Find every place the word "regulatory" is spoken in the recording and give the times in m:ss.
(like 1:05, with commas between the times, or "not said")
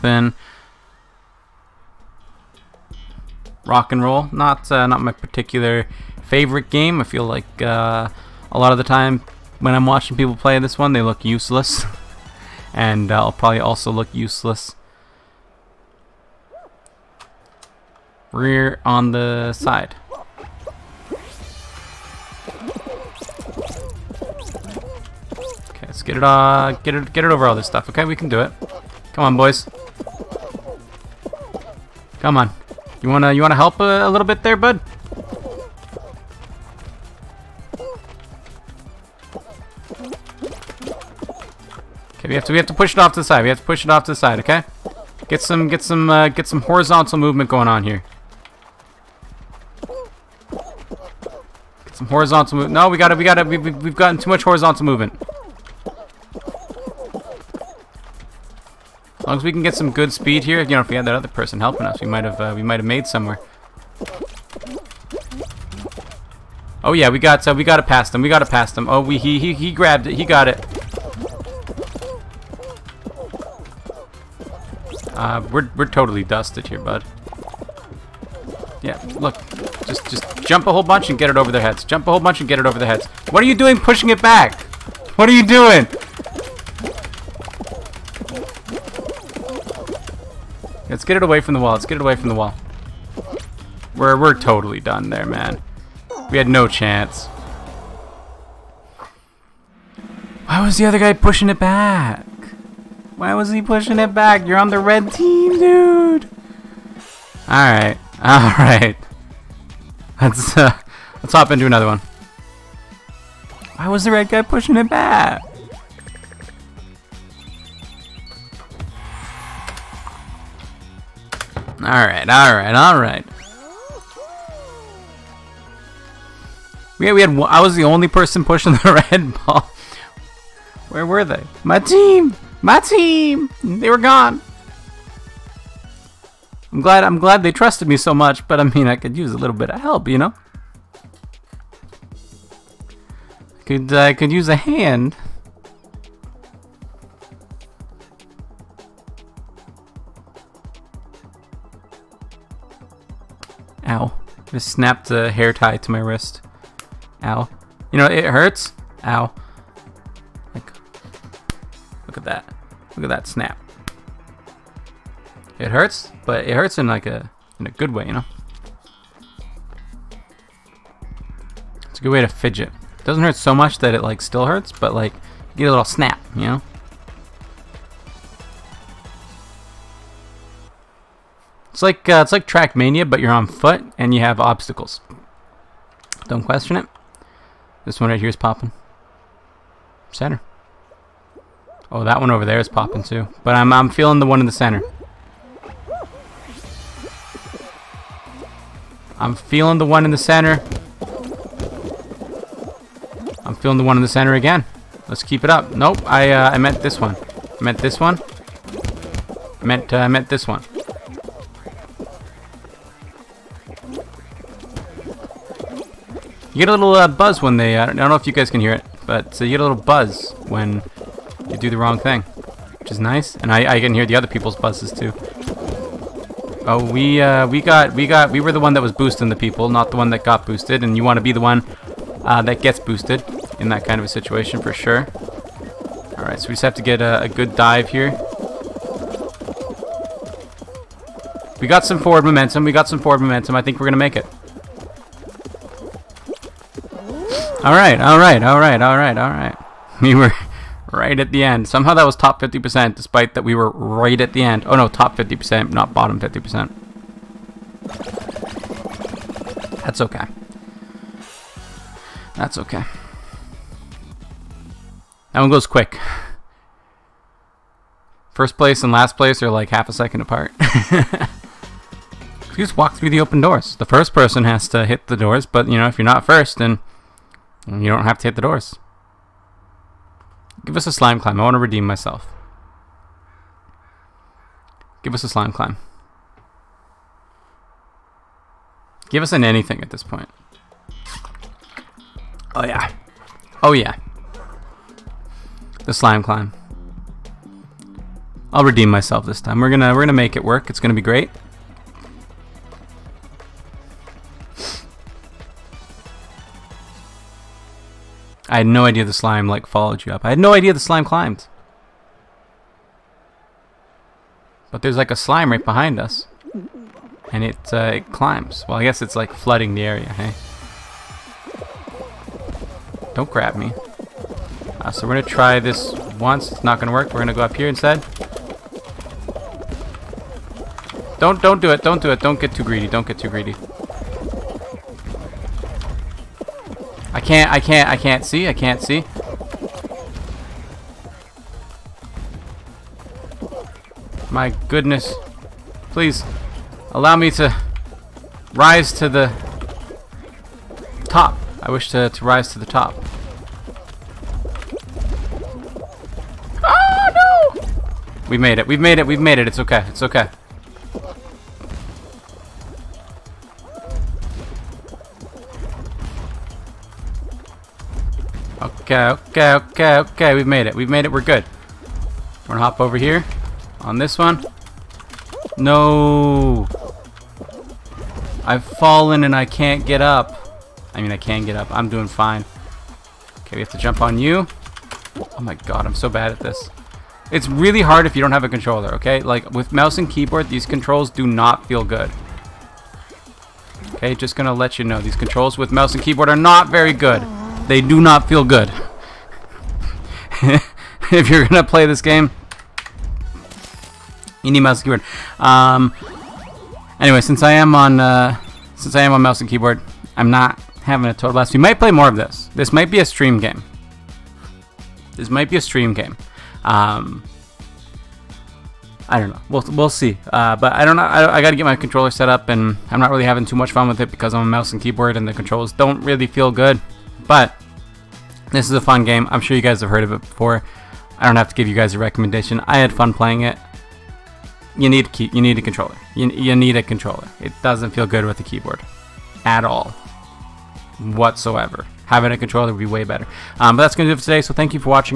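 not said.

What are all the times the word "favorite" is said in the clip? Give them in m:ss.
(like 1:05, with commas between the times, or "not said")
0:06.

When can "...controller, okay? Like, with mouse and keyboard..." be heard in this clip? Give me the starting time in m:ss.
6:28.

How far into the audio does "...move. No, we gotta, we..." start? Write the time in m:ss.
0:52.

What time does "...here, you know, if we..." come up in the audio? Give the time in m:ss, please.
1:00.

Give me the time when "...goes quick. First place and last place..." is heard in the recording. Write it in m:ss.
4:25.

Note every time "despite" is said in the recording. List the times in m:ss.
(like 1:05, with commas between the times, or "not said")
4:12.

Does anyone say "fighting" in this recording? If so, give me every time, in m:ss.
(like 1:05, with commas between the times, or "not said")
not said.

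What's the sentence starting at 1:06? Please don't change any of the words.
Oh yeah, we got, uh, we gotta pass them.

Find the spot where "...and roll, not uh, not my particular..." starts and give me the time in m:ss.
0:03.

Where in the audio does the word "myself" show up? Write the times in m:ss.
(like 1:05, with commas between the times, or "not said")
4:41, 4:58.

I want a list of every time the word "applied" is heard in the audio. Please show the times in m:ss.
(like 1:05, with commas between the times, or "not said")
not said.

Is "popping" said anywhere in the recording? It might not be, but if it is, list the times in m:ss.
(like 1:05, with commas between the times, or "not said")
3:08, 3:12.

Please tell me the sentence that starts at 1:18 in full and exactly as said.
Yeah, look, just, just jump a whole bunch and get it over their heads.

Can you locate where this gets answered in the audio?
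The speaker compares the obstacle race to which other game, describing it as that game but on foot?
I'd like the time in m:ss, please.
3:02.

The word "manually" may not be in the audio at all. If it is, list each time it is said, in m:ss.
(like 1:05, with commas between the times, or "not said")
not said.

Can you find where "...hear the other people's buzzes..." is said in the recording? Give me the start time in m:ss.
3:43.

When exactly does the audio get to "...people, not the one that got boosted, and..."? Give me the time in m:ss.
3:49.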